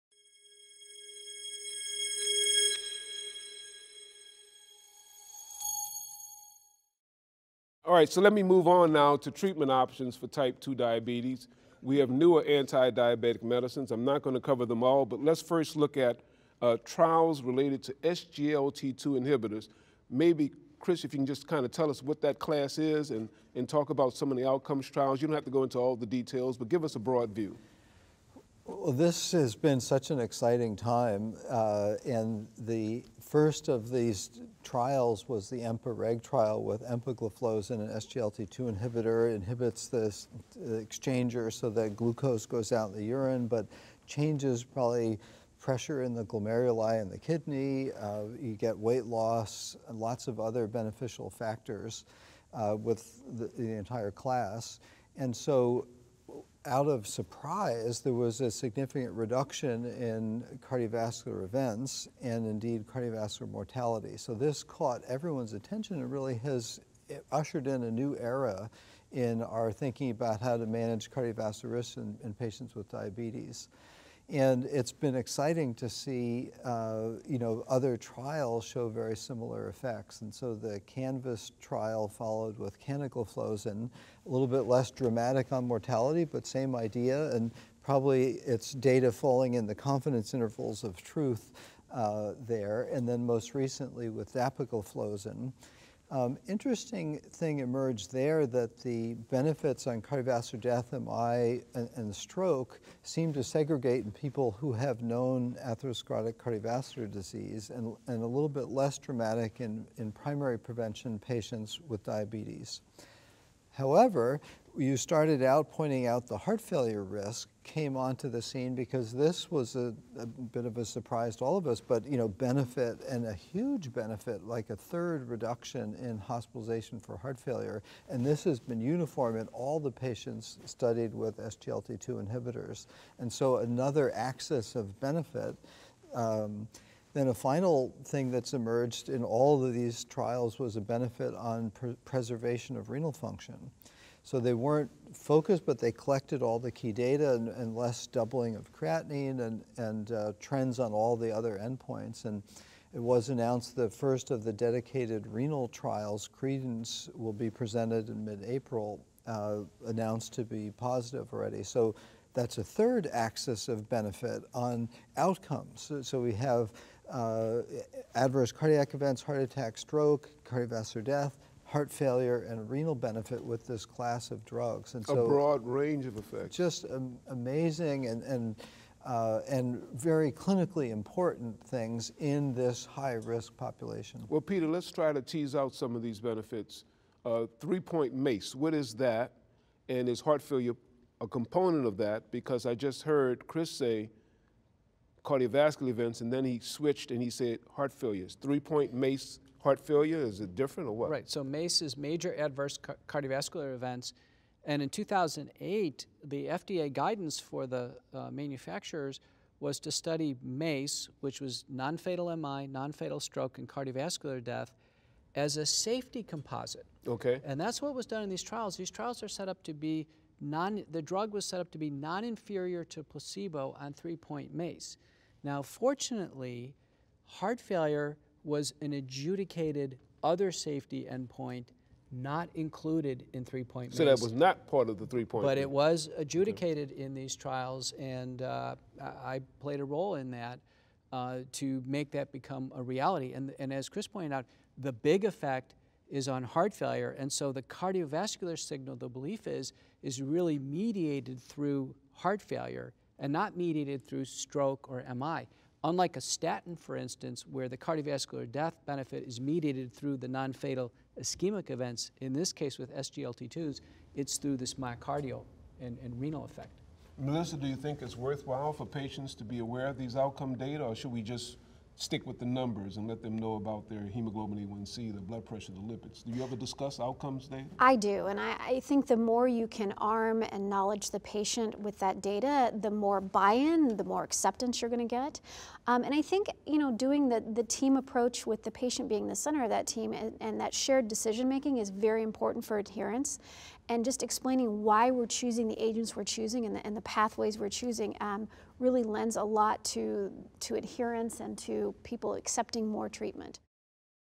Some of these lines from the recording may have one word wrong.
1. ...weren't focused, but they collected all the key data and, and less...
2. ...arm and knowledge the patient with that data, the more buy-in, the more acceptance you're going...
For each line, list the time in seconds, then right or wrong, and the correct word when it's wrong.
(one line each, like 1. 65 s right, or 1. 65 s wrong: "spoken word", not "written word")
1. 144 s right
2. 279 s right.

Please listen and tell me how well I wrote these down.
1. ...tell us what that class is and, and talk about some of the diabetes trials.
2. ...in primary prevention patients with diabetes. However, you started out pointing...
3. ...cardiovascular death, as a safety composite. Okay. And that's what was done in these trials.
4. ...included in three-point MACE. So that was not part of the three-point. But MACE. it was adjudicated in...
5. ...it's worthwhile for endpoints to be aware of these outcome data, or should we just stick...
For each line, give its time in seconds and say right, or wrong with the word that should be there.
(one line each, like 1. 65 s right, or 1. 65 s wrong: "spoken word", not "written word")
1. 21 s wrong: "outcomes", not "diabetes"
2. 109 s right
3. 213 s right
4. 232 s right
5. 268 s wrong: "patients", not "endpoints".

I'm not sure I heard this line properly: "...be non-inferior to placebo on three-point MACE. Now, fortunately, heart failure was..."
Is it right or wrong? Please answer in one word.
right.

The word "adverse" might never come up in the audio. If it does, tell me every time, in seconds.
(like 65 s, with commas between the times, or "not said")
168 s, 202 s.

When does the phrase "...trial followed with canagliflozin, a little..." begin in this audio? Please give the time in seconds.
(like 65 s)
81 s.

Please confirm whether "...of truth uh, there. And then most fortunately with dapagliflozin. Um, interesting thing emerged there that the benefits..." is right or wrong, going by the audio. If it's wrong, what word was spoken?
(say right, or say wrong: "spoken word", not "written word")
wrong: "recently", not "fortunately".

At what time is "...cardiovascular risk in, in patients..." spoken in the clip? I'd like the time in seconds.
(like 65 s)
71 s.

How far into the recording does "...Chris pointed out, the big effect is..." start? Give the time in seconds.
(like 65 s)
243 s.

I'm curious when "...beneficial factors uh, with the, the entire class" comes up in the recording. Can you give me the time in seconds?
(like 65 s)
50 s.